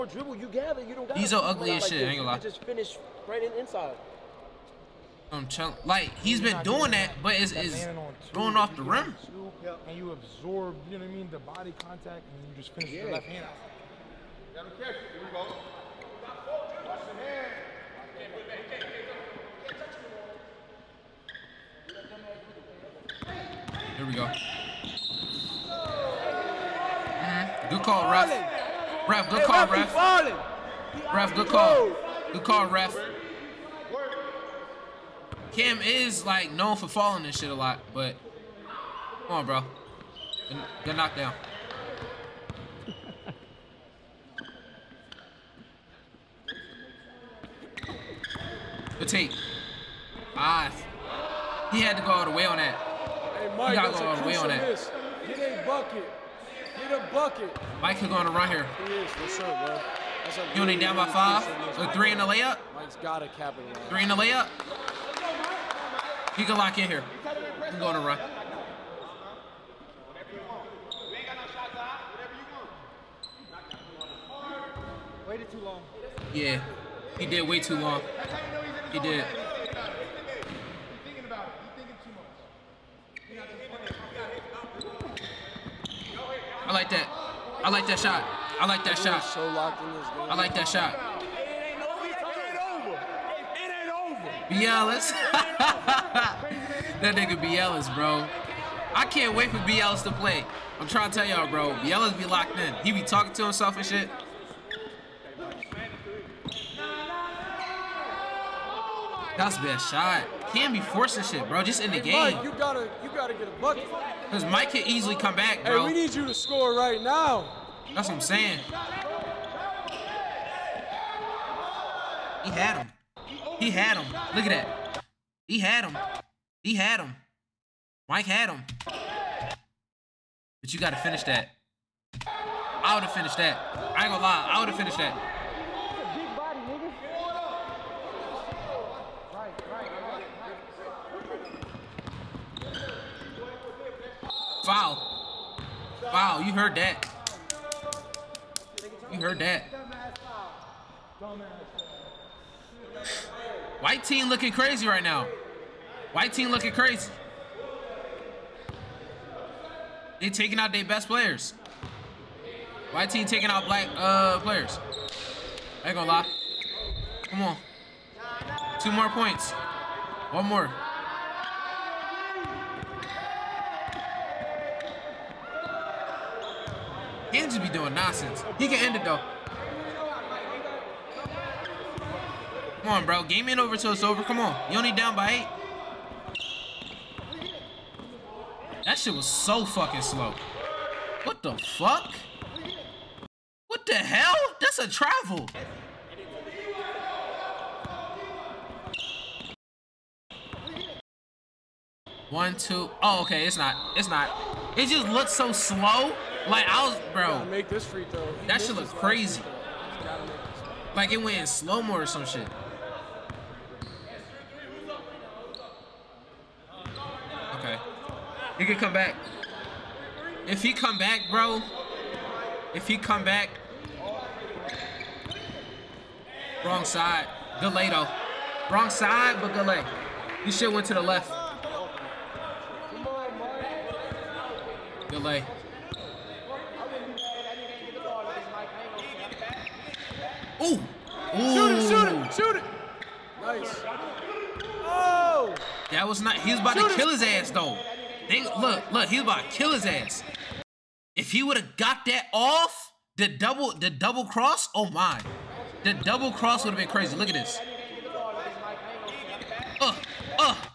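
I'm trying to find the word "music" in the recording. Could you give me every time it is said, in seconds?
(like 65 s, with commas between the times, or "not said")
not said.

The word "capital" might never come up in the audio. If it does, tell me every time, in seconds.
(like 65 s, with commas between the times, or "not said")
63 s.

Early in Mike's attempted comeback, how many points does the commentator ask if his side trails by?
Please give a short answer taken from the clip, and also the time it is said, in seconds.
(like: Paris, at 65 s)
5, at 61 s.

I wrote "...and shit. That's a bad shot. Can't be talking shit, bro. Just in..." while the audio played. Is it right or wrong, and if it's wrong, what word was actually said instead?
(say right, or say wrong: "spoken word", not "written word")
wrong: "forcing", not "talking".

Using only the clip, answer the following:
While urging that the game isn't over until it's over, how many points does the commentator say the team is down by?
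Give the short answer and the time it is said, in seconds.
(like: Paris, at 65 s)
8, at 185 s.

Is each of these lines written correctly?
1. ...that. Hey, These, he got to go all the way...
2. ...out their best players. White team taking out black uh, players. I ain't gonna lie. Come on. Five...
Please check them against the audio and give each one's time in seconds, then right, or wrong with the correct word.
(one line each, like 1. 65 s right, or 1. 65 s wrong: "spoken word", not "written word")
1. 52 s wrong: "Mike", not "These"
2. 160 s wrong: "Two", not "Five".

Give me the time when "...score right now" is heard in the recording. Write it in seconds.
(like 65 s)
116 s.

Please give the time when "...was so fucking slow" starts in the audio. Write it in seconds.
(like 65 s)
189 s.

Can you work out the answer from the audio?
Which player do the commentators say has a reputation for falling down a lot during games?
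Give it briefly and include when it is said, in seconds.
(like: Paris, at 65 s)
Kam, at 35 s.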